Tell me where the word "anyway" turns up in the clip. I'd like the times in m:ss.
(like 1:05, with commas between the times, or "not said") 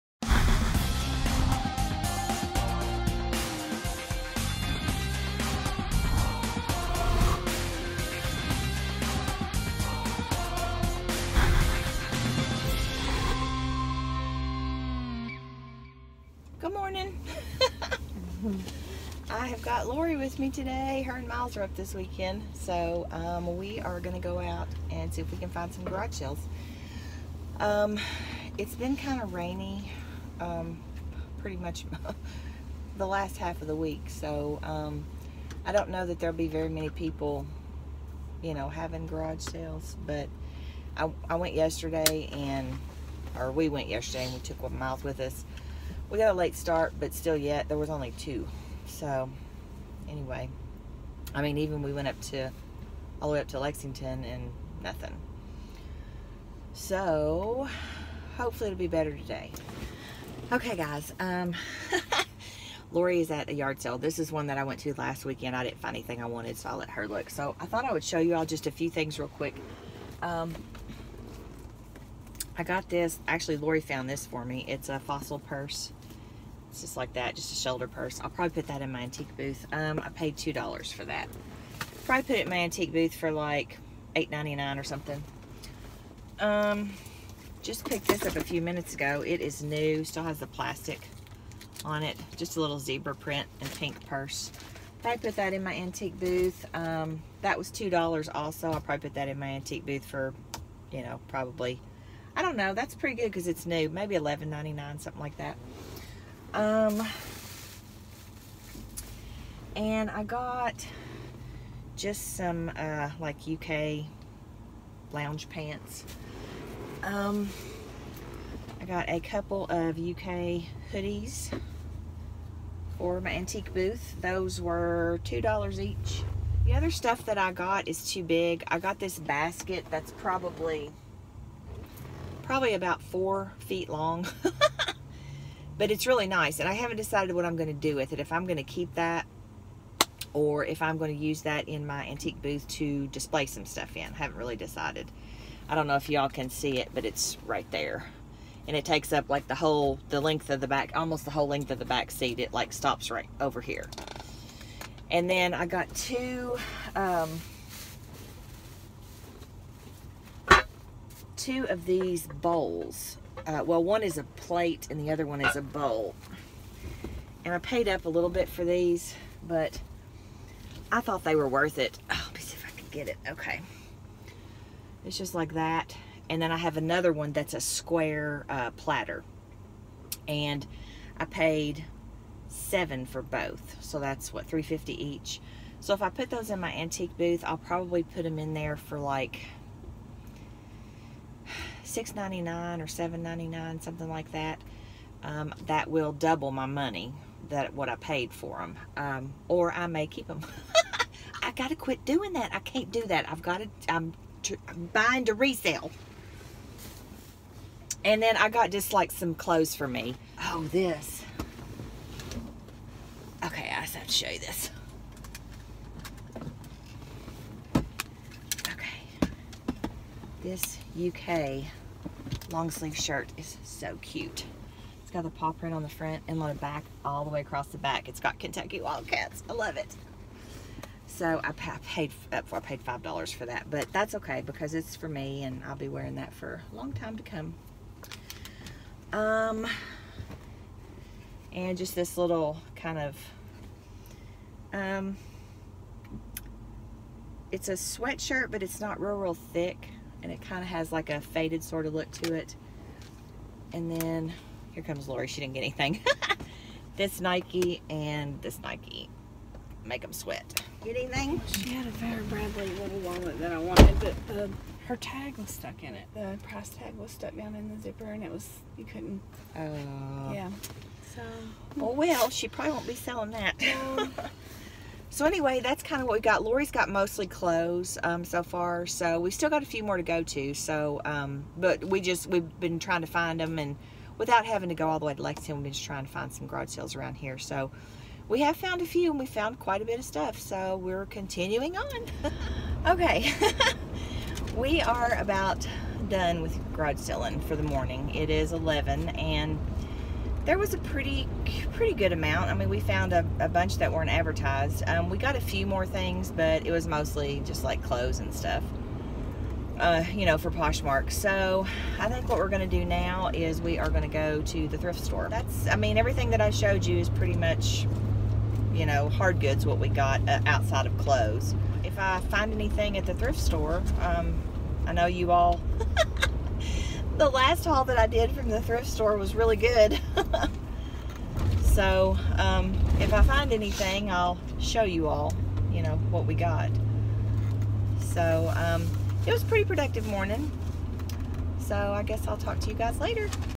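0:50, 4:35.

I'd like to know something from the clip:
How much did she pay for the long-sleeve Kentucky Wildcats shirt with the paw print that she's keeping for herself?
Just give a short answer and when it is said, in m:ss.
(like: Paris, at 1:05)
$5, at 3:52.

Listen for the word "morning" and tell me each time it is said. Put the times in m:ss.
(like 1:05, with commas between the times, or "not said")
4:57, 5:40.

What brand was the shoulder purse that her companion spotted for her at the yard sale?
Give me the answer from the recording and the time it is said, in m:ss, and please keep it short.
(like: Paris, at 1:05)
Fossil, at 1:14.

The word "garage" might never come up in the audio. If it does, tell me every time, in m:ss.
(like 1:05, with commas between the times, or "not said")
0:25, 0:39, 4:46, 4:56.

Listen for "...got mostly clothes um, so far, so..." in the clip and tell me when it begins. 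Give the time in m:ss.
4:36.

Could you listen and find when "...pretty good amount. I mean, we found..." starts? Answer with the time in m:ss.
5:01.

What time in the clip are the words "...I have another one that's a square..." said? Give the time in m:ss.
2:56.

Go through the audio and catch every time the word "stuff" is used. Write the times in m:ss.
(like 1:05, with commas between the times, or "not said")
2:06, 2:23, 4:50, 5:08.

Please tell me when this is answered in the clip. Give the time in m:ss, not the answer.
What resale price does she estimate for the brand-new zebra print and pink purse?
1:44.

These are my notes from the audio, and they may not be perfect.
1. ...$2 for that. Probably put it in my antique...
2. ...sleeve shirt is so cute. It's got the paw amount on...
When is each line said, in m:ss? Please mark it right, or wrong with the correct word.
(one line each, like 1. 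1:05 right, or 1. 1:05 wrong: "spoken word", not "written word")
1. 1:20 right
2. 3:42 wrong: "print", not "amount".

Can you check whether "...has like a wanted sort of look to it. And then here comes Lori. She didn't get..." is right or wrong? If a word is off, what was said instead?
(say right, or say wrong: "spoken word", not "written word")
wrong: "faded", not "wanted".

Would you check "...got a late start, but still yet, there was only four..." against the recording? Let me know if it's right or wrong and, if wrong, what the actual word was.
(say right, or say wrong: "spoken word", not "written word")
wrong: "two", not "four".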